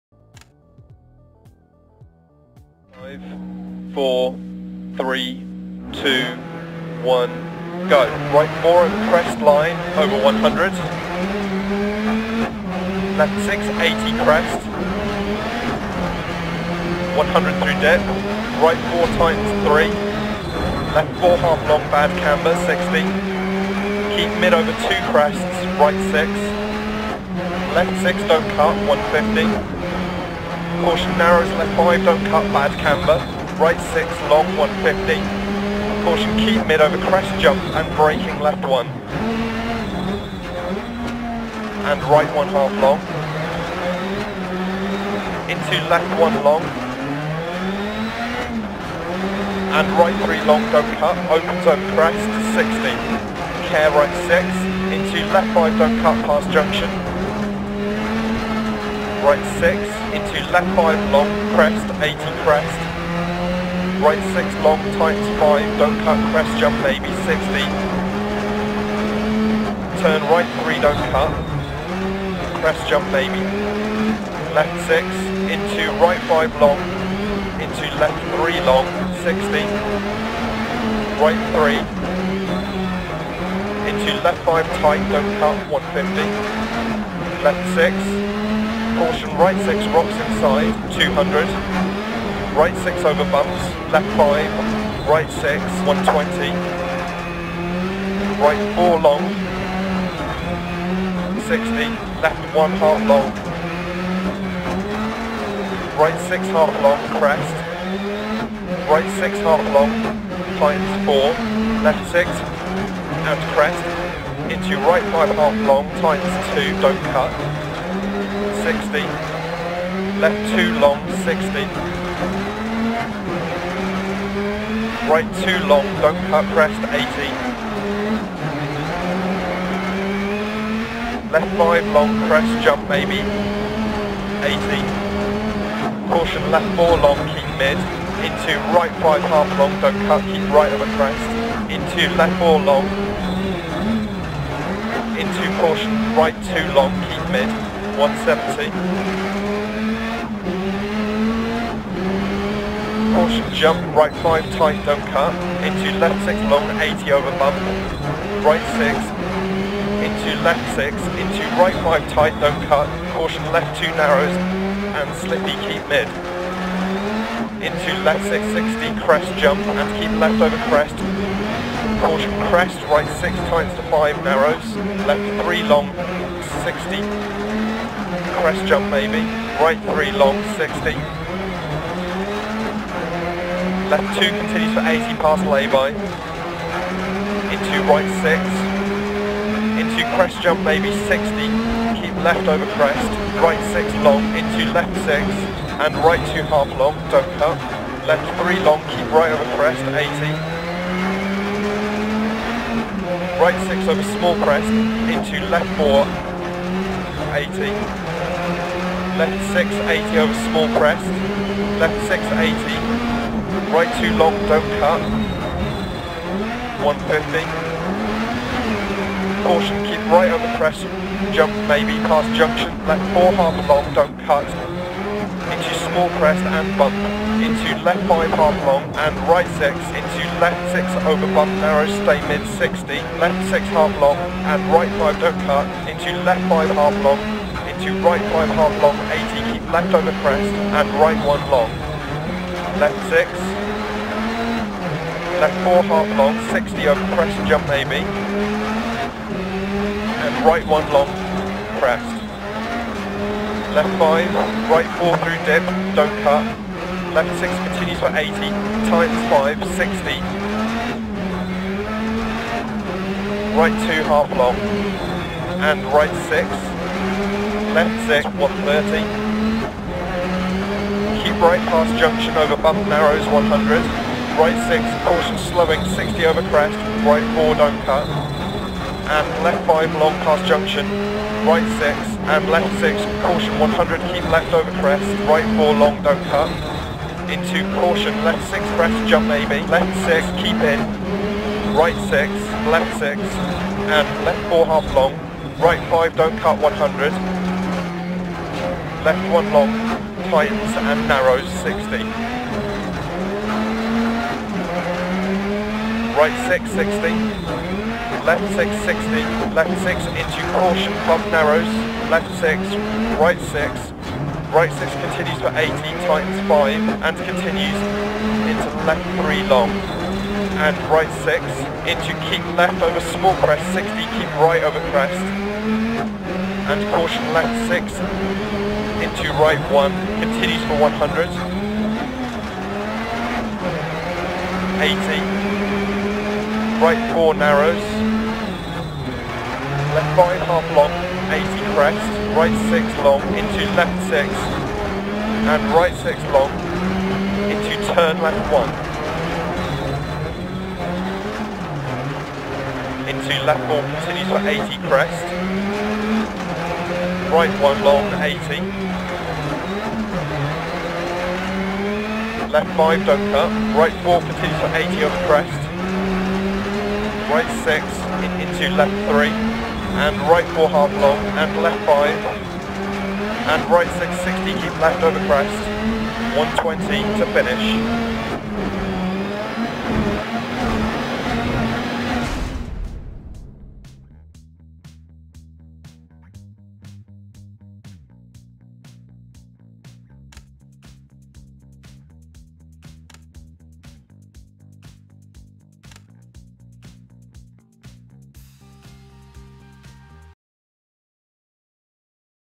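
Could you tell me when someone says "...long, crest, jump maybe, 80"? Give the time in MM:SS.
02:11.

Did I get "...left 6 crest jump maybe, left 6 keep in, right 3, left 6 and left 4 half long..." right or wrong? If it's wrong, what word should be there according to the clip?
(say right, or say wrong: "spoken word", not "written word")
wrong: "6", not "3".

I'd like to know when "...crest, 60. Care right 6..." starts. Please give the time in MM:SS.
00:51.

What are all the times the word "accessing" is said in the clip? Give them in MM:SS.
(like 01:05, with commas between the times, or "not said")
not said.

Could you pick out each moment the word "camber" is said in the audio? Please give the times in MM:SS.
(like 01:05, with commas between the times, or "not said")
00:22, 00:32.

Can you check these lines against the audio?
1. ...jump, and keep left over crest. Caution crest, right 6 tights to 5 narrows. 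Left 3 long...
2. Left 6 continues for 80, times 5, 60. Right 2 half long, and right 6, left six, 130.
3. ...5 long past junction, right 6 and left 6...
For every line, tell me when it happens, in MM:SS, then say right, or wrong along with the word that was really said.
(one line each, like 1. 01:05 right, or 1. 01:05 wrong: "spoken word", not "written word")
1. 02:49 right
2. 04:17 right
3. 04:39 right.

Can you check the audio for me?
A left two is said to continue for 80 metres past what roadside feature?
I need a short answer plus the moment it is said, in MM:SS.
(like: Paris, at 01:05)
lay-by, at 03:05.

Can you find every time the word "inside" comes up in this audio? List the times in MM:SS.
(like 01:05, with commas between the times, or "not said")
01:30.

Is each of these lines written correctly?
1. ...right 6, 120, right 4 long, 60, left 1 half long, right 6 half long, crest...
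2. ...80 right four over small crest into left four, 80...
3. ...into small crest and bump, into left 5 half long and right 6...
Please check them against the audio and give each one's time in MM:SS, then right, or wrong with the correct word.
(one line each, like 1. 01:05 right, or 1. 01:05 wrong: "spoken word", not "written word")
1. 01:35 right
2. 03:19 wrong: "six", not "four"
3. 03:45 right.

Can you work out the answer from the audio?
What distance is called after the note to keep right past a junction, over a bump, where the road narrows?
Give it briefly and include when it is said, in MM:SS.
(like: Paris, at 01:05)
100, at 04:32.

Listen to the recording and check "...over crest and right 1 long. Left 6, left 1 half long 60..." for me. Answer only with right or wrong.
wrong.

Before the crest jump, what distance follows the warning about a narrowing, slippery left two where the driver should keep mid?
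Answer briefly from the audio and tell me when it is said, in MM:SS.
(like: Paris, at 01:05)
170, at 02:28.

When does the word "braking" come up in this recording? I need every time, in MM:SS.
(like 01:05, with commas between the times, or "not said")
00:37.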